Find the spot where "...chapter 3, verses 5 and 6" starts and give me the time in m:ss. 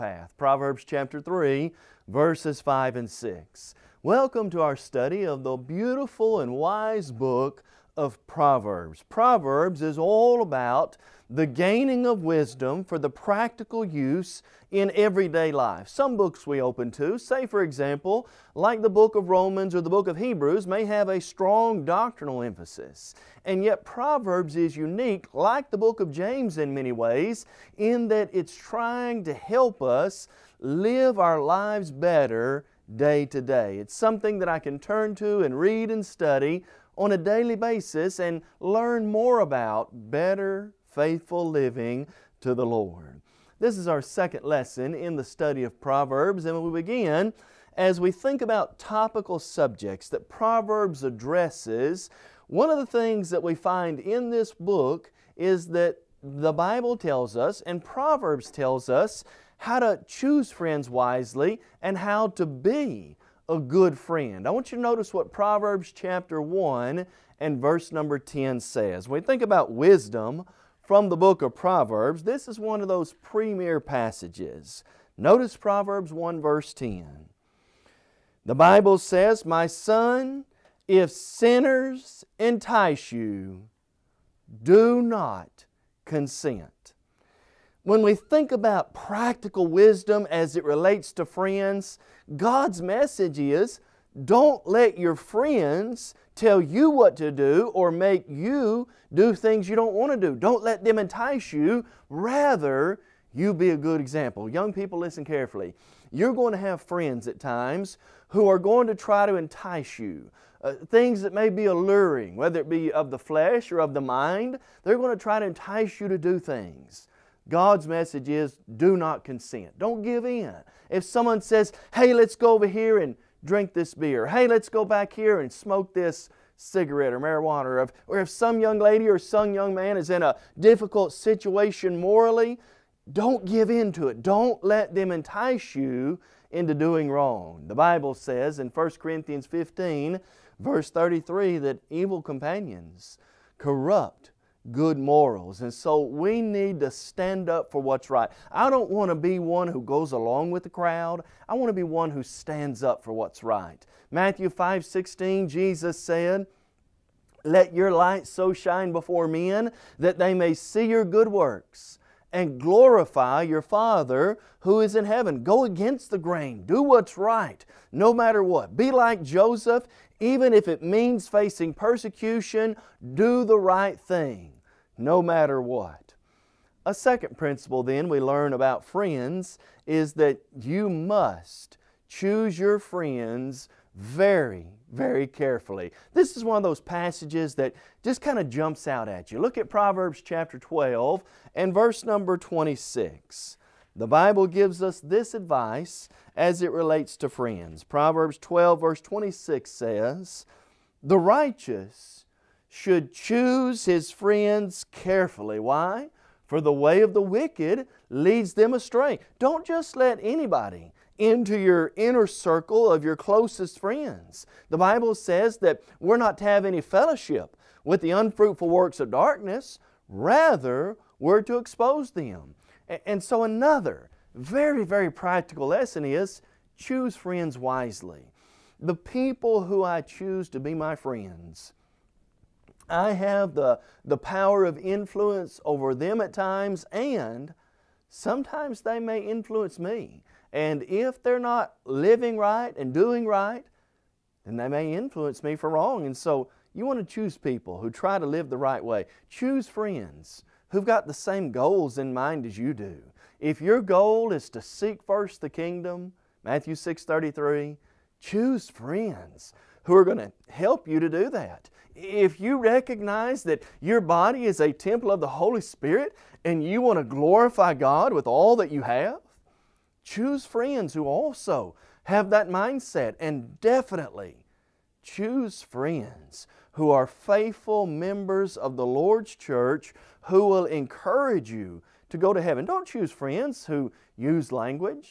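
0:00.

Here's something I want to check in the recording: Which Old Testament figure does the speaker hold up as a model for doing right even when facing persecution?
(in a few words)
Joseph.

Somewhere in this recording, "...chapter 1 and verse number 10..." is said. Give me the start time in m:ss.
1:05.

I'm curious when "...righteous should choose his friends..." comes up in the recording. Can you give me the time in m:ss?
3:21.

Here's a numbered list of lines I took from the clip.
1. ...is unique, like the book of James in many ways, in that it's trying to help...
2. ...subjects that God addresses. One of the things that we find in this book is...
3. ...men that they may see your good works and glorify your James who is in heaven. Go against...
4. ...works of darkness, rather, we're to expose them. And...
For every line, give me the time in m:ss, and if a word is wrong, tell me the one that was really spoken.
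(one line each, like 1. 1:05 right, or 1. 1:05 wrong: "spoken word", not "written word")
1. 0:24 right
2. 0:49 wrong: "Proverbs", not "God"
3. 2:39 wrong: "Father", not "James"
4. 3:38 right.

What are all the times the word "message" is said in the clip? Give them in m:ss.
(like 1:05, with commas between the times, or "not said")
1:32, 1:57.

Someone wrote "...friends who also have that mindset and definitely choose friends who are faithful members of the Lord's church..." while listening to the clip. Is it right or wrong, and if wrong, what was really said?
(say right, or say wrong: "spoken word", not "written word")
right.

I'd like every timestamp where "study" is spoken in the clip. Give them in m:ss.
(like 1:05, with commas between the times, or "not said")
0:04, 0:36, 0:45.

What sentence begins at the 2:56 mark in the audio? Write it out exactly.
A second principle, then, we learn about friends is that you must choose your friends very, very carefully.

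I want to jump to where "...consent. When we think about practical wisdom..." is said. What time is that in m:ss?
1:26.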